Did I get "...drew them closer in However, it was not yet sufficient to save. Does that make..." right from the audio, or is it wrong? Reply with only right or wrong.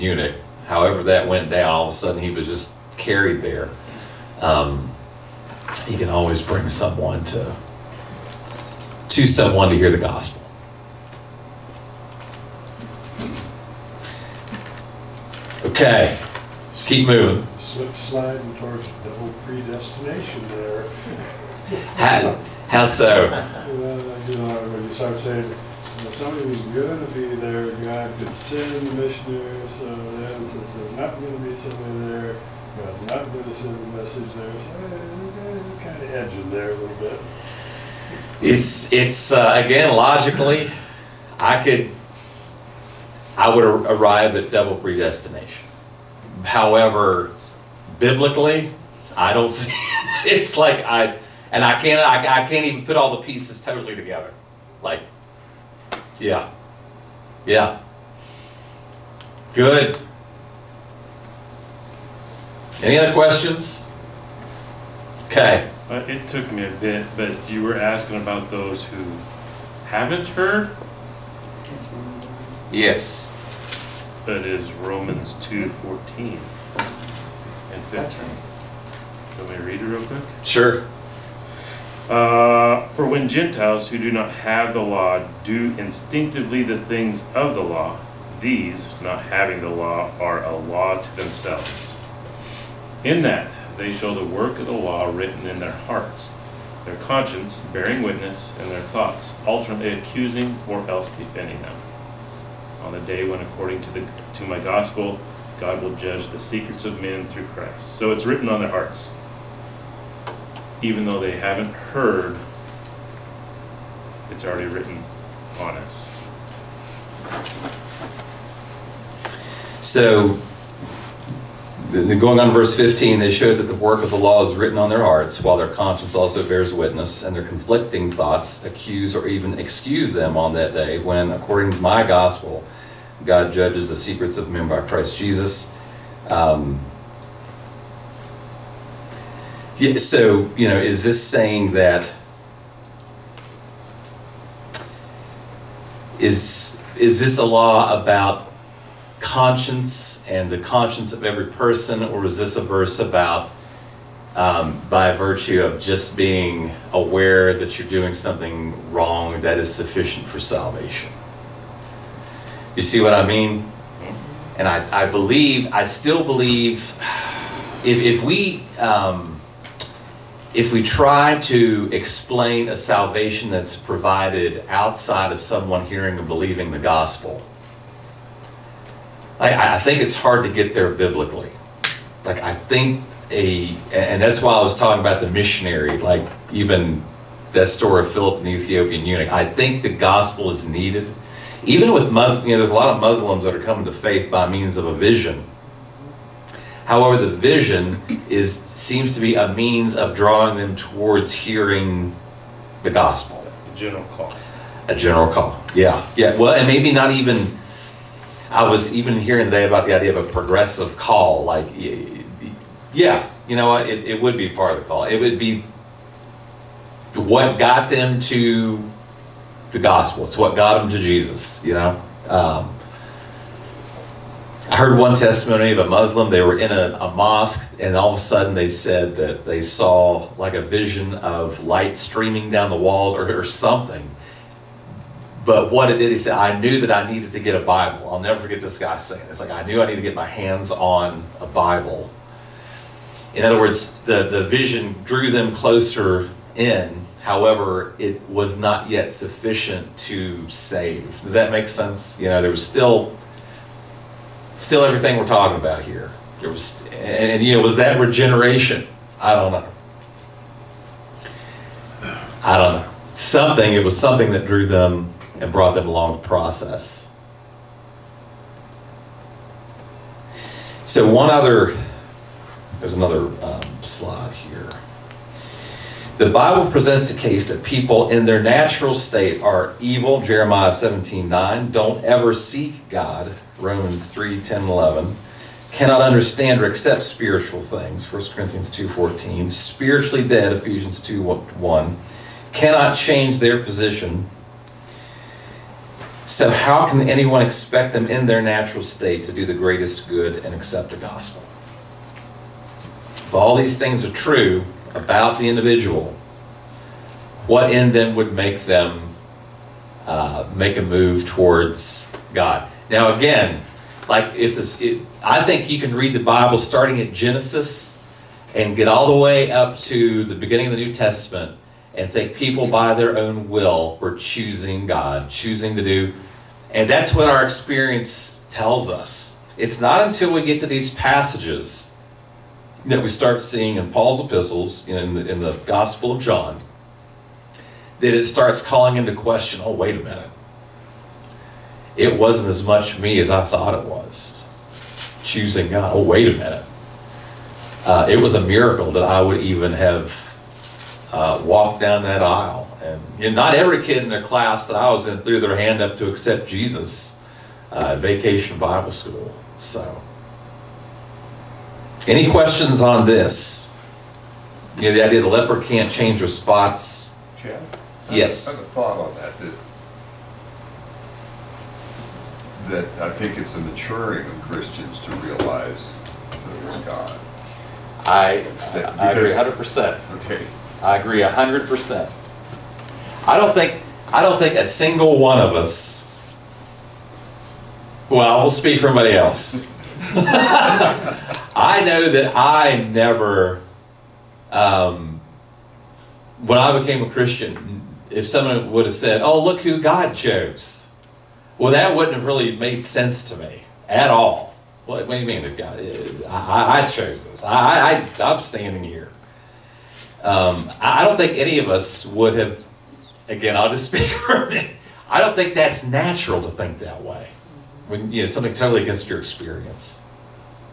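right.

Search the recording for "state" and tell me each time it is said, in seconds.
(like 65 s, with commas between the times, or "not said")
278 s, 298 s.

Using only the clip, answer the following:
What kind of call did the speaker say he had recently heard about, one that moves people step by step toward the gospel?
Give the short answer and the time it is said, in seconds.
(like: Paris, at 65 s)
progressive call, at 210 s.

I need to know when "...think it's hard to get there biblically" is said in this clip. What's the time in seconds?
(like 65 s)
179 s.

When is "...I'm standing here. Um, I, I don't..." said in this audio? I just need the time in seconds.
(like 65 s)
408 s.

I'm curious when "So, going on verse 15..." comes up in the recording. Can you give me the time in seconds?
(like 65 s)
119 s.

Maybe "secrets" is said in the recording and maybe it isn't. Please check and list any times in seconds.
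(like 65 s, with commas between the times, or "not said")
106 s, 133 s.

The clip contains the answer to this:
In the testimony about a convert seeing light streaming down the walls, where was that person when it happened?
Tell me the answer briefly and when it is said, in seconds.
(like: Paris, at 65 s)
a mosque, at 227 s.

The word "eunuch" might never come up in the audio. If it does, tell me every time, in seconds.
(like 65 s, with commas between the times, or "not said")
0 s, 189 s.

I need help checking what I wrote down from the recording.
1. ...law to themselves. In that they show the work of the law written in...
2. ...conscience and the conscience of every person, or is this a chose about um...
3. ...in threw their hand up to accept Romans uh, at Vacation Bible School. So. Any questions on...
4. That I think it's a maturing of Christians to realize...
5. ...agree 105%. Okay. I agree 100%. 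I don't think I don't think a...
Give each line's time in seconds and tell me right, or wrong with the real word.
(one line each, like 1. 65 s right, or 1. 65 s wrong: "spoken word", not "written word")
1. 90 s right
2. 149 s wrong: "verse", not "chose"
3. 355 s wrong: "Jesus", not "Romans"
4. 372 s right
5. 379 s wrong: "100", not "105".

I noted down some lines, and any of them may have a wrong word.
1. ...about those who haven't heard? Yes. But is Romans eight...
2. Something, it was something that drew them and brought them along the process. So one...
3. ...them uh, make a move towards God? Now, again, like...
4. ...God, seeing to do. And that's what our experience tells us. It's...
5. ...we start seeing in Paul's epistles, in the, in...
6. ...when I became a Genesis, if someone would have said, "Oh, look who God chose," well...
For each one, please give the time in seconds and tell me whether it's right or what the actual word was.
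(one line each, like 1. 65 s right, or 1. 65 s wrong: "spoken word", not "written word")
1. 68 s wrong: "two", not "eight"
2. 263 s right
3. 308 s right
4. 324 s wrong: "choosing", not "seeing"
5. 333 s right
6. 396 s wrong: "Christian", not "Genesis".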